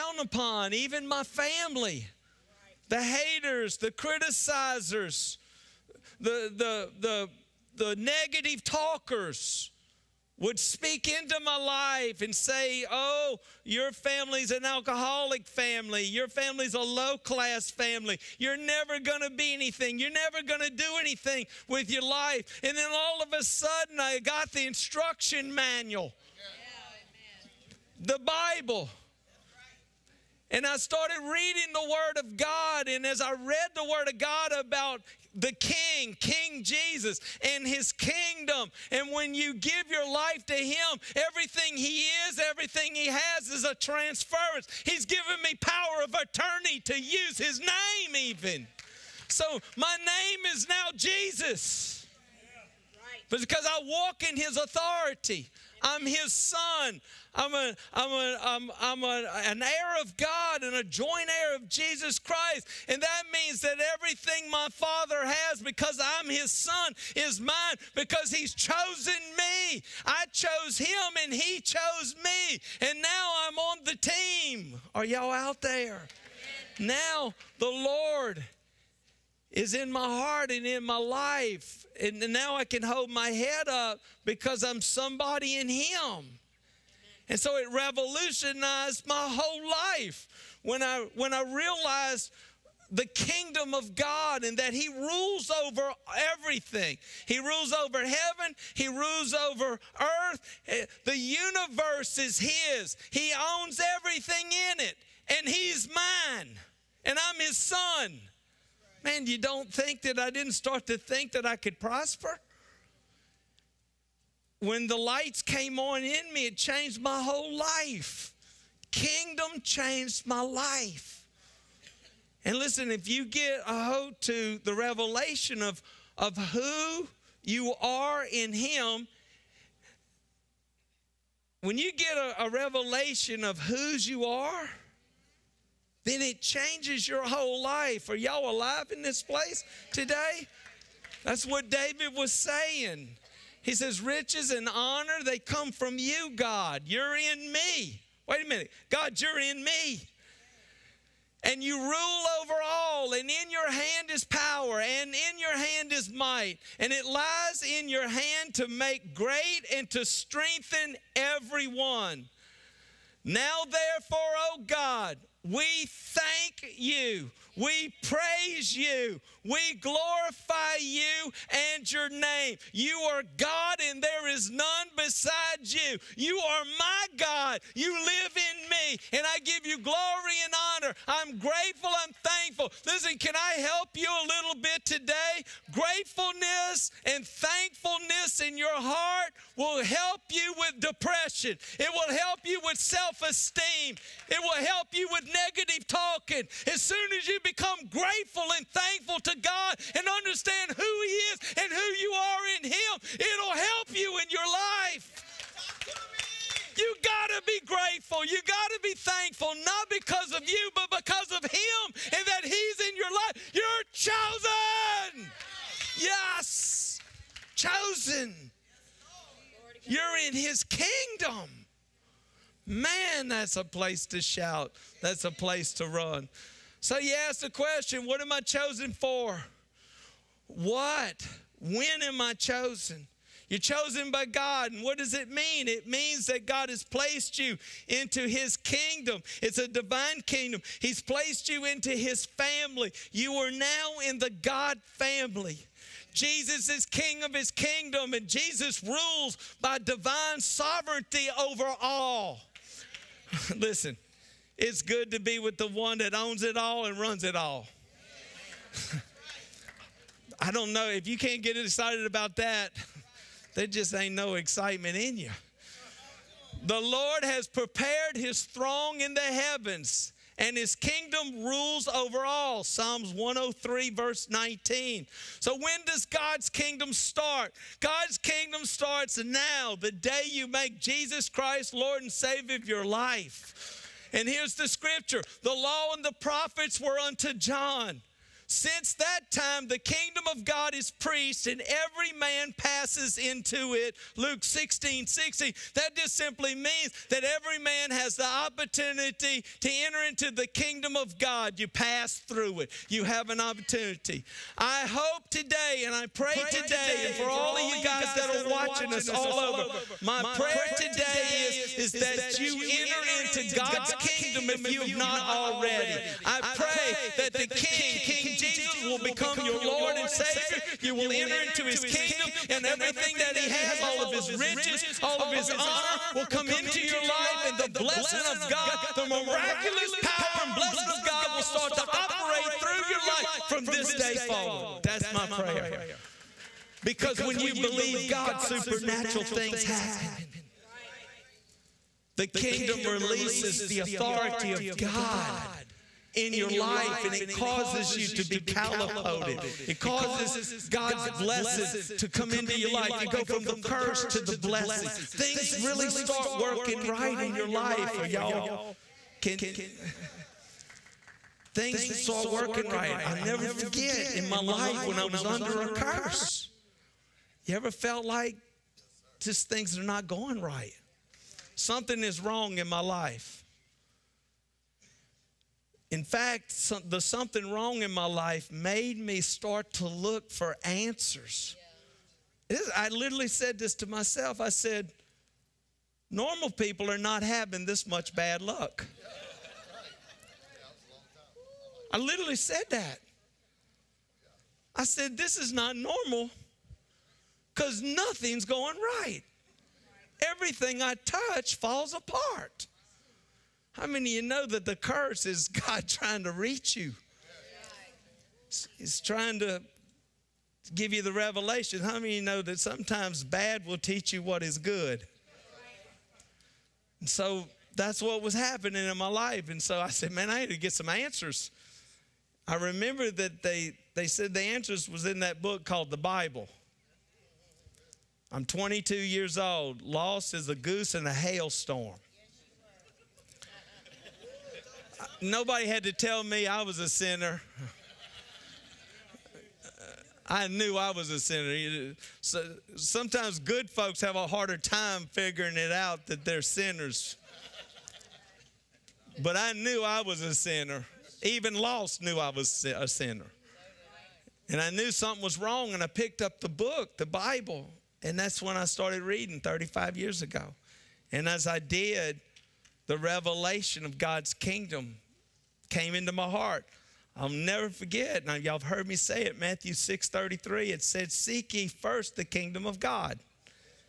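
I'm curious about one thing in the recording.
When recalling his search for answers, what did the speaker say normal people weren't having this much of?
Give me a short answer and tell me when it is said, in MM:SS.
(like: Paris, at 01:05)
bad luck, at 06:28.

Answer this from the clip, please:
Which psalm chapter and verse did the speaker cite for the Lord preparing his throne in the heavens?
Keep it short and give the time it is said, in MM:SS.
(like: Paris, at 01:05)
Psalms 103:19, at 04:32.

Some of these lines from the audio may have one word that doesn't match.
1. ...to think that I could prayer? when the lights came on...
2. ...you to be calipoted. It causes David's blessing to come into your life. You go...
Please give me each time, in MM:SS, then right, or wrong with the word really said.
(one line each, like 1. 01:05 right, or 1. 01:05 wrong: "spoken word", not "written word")
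1. 01:50 wrong: "prosper", not "prayer"
2. 05:47 wrong: "God", not "David".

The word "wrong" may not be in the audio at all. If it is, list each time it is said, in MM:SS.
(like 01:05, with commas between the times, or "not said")
06:12, 06:17, 07:35.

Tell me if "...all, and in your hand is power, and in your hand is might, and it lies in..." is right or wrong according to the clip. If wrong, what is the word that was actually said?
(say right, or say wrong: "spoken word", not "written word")
right.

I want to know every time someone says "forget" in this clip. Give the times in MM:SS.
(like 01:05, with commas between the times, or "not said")
06:03, 07:47.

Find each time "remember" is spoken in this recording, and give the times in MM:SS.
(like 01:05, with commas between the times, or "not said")
07:02.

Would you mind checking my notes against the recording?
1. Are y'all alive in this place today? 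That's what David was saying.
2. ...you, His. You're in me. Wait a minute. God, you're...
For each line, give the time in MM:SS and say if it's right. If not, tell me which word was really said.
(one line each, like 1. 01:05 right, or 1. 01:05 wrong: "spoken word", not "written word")
1. 02:18 right
2. 02:25 wrong: "God", not "His".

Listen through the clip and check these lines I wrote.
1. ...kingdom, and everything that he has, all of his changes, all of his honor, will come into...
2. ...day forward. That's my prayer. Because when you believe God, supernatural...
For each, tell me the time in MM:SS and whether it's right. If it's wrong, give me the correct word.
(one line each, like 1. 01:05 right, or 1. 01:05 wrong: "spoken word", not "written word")
1. 05:21 wrong: "riches", not "changes"
2. 05:33 right.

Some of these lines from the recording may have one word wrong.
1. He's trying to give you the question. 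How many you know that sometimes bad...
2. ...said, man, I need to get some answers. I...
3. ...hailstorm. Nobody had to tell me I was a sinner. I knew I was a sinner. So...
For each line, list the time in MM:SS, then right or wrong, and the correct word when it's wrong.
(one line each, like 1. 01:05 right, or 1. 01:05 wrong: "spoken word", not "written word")
1. 06:48 wrong: "revelation", not "question"
2. 06:59 right
3. 07:11 right.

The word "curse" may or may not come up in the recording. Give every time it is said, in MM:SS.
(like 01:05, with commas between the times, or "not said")
05:53, 06:05, 06:44.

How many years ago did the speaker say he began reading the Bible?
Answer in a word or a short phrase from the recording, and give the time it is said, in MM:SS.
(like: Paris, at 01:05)
35, at 07:39.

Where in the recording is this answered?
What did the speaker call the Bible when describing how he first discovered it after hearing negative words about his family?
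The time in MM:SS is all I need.
00:24.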